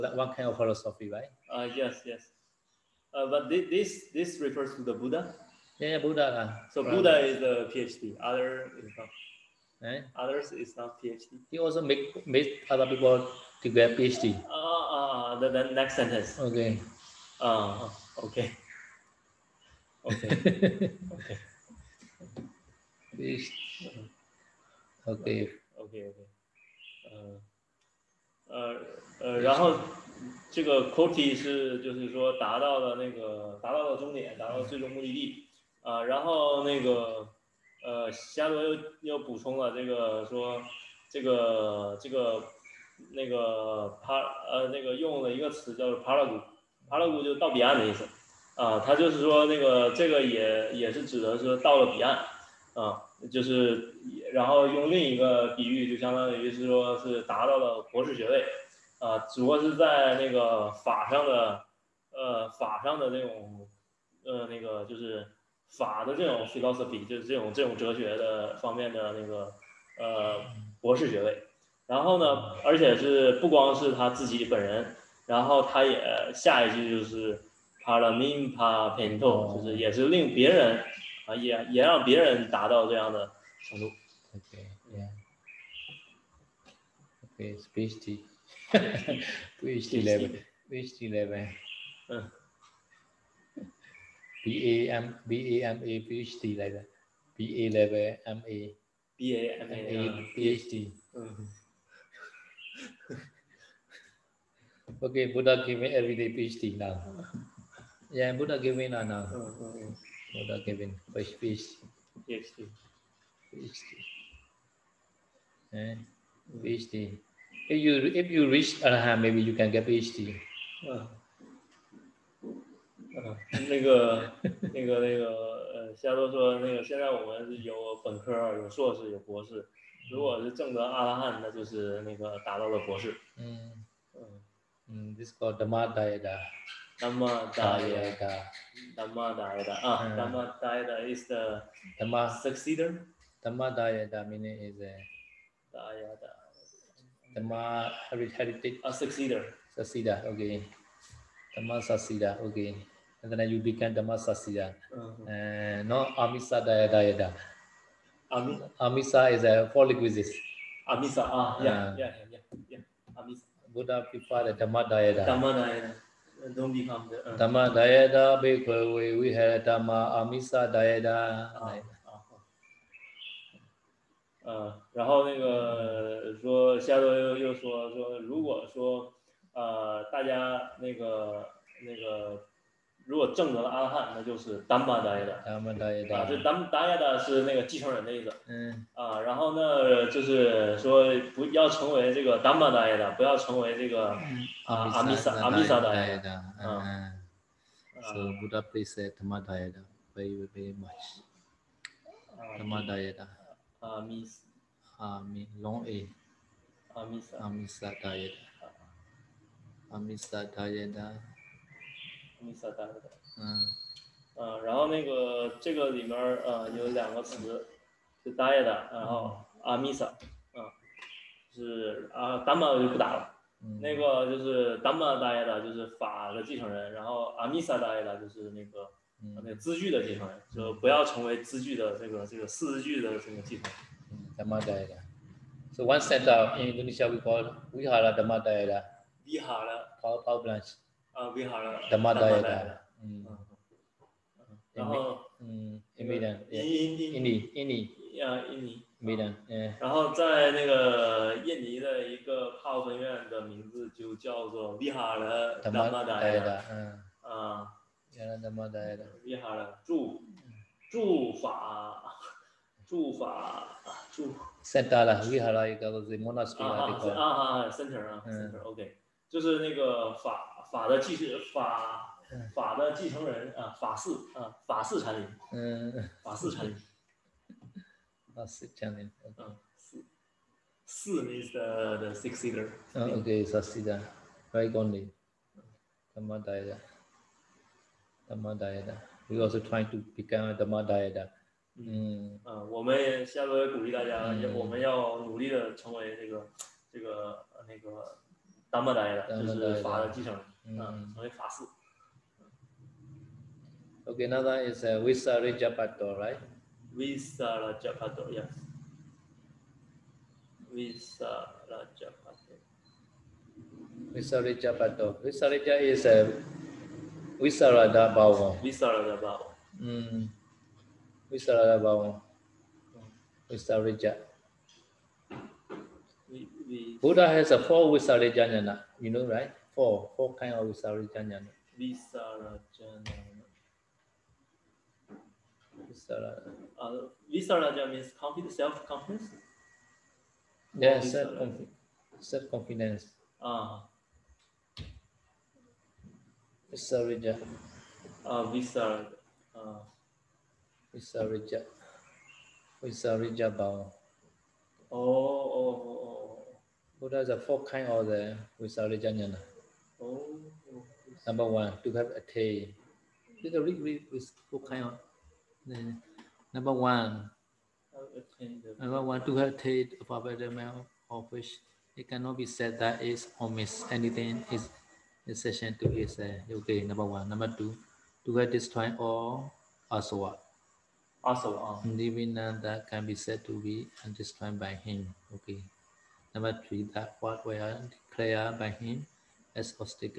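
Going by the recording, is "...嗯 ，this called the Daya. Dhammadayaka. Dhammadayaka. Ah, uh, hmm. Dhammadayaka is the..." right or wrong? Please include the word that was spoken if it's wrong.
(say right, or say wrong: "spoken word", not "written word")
right.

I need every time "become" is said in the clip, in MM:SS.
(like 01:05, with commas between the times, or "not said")
02:33, 04:50.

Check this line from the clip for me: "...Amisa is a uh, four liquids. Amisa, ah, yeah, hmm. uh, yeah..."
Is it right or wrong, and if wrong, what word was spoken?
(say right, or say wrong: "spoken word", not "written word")
right.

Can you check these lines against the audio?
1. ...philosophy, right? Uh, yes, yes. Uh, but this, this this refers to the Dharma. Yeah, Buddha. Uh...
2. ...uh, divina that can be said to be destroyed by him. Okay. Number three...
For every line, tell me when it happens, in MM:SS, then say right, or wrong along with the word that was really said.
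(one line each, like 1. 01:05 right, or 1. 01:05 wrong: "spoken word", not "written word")
1. 00:00 wrong: "Buddha", not "Dharma"
2. 06:21 right.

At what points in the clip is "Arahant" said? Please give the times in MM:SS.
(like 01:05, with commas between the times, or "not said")
01:58.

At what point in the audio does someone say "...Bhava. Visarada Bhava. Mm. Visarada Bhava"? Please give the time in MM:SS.
05:18.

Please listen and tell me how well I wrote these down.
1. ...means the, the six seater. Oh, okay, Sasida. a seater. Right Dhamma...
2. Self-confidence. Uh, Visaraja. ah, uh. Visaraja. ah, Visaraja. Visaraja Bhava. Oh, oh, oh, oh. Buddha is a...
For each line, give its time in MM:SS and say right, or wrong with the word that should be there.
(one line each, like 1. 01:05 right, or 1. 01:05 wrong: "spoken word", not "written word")
1. 04:41 right
2. 05:46 right.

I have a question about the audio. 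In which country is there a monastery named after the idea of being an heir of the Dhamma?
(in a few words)
Indonesia.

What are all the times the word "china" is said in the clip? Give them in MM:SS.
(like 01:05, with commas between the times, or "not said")
not said.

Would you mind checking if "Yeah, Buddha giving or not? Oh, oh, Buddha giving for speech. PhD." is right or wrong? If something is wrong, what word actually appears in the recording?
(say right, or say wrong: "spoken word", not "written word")
right.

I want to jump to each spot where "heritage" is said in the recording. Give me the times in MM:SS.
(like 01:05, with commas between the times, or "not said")
02:28, 06:09.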